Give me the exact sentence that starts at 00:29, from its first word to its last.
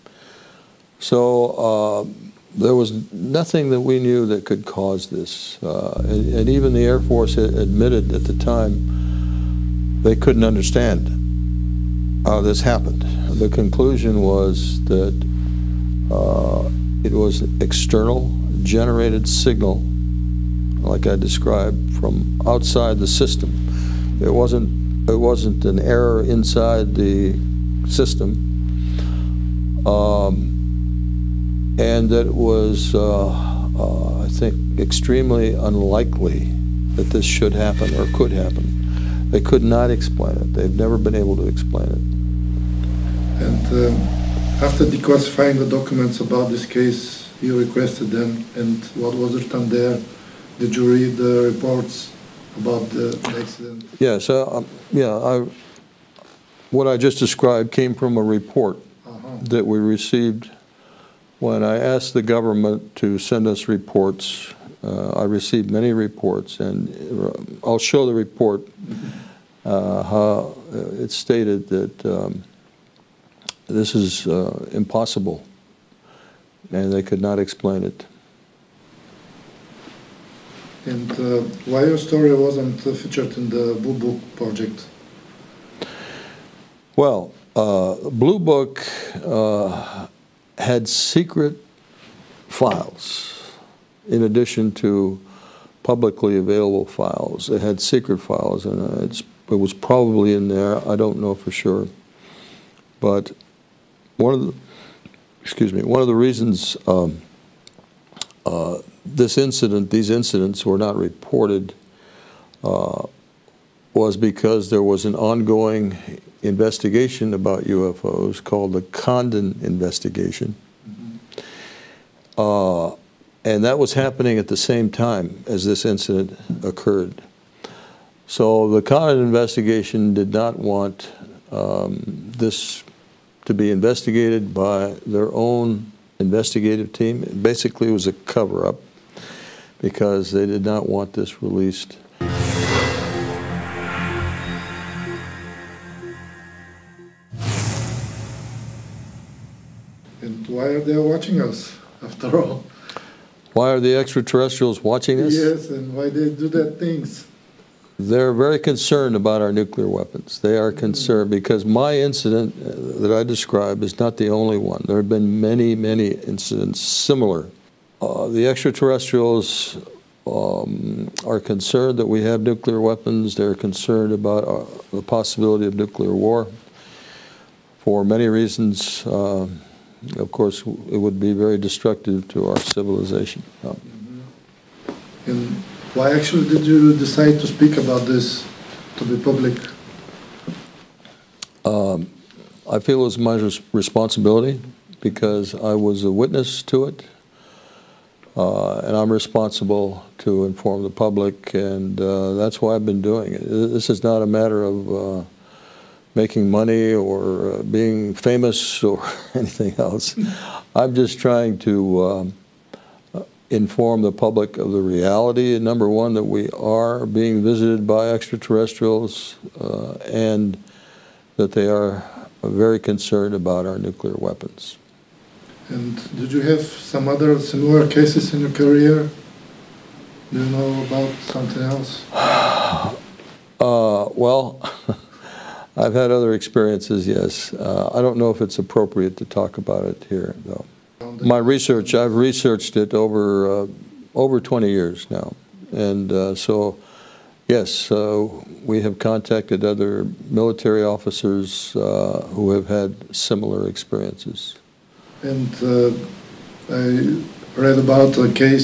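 Um, and that it was, uh, uh, I think, extremely unlikely that this should happen or could happen.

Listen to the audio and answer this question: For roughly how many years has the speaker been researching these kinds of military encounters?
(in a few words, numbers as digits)
over 20 years.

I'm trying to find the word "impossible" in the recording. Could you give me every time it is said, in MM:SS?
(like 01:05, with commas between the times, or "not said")
01:14.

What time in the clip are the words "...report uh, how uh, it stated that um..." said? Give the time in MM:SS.
01:08.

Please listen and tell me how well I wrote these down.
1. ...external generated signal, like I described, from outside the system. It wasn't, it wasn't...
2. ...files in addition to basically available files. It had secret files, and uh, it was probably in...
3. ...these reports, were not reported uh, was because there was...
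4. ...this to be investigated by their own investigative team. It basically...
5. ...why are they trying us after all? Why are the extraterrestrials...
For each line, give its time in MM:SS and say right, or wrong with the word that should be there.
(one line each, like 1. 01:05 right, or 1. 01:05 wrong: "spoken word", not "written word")
1. 00:17 right
2. 01:32 wrong: "publicly", not "basically"
3. 01:49 wrong: "incidents", not "reports"
4. 02:12 right
5. 02:30 wrong: "watching", not "trying".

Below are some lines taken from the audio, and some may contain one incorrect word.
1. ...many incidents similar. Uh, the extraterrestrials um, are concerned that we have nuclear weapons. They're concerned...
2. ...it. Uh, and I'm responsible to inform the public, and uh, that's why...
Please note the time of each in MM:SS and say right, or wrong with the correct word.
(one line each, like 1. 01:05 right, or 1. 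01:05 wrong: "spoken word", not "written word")
1. 02:45 right
2. 03:16 right.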